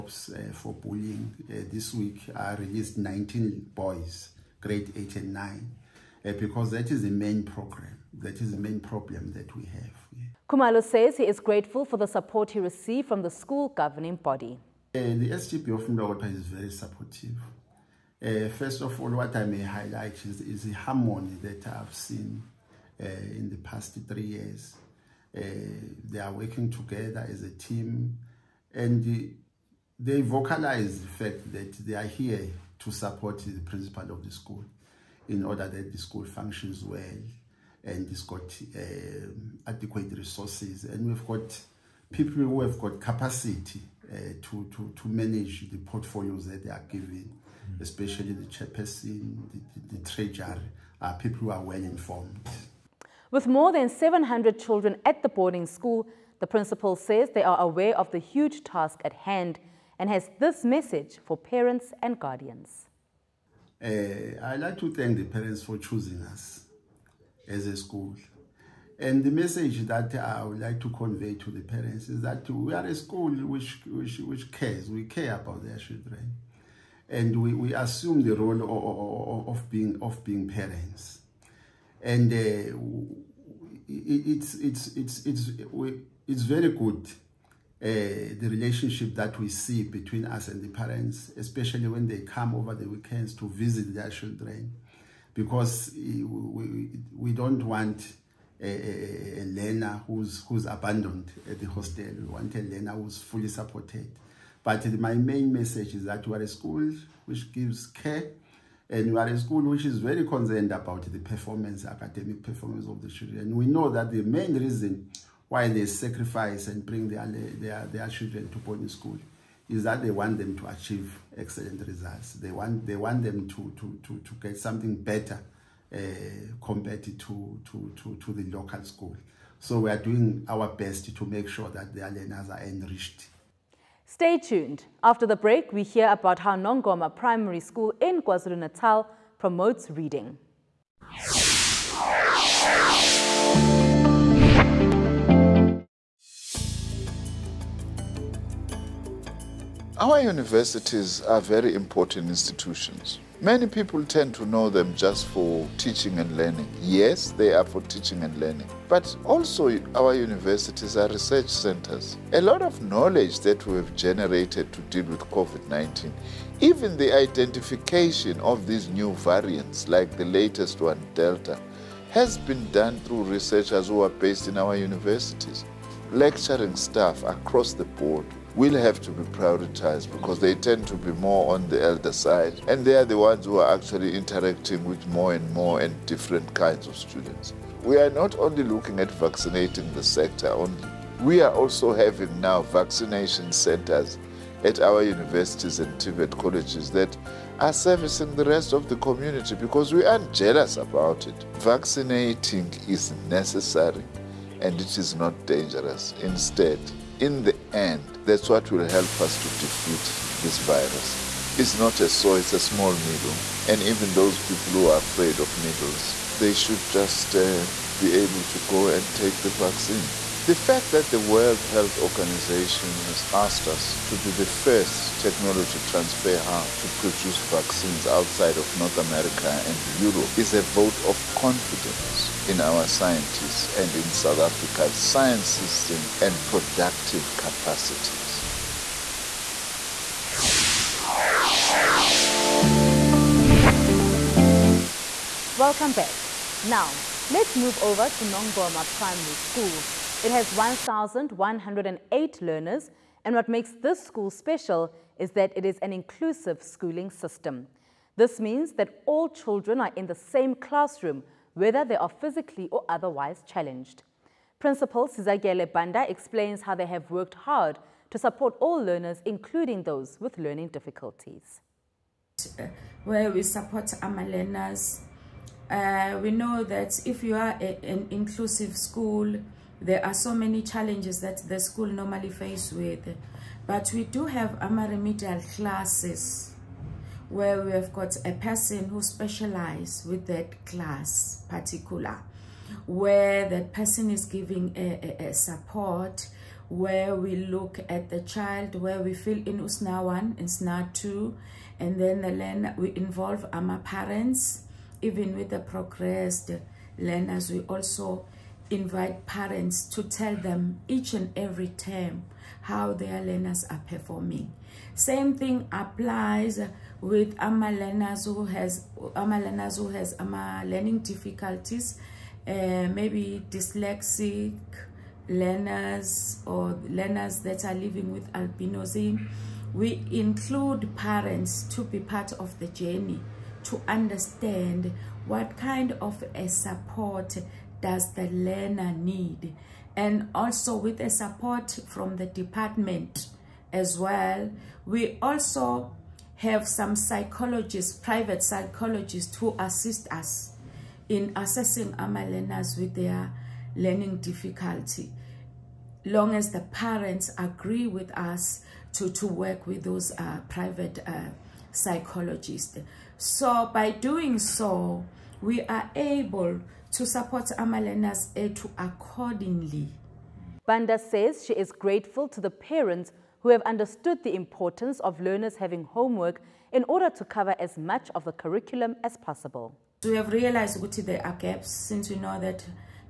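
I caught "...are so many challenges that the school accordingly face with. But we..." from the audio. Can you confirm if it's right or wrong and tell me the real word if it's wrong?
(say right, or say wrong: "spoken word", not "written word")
wrong: "normally", not "accordingly".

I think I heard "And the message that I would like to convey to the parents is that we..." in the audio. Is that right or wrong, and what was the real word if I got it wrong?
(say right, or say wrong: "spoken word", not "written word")
right.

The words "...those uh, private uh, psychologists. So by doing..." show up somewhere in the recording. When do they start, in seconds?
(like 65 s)
359 s.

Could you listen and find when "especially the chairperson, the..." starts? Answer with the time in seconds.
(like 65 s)
47 s.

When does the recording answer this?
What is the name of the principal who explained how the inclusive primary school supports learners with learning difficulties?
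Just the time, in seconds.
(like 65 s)
265 s.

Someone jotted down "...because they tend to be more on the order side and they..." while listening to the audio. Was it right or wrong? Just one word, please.
wrong.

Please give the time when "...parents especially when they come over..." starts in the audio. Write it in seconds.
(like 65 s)
90 s.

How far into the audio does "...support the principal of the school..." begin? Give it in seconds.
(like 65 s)
32 s.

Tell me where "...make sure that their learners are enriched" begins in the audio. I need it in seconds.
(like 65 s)
131 s.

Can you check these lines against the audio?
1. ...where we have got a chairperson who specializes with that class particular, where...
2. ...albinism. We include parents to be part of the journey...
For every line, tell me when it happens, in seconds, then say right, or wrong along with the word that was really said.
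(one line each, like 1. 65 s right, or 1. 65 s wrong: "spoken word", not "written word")
1. 287 s wrong: "person", not "chairperson"
2. 328 s right.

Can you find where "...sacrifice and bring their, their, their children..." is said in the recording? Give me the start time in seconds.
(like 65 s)
115 s.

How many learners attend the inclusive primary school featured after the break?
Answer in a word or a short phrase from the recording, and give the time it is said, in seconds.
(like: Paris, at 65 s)
1,108, at 250 s.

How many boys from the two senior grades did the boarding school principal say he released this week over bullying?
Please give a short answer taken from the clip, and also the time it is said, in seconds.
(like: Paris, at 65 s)
19, at 2 s.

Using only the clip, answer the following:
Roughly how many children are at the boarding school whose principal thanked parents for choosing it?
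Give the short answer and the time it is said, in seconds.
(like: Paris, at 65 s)
more than 700, at 53 s.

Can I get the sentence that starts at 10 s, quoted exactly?
Kumalo says he is grateful for the support he received from the school governing body.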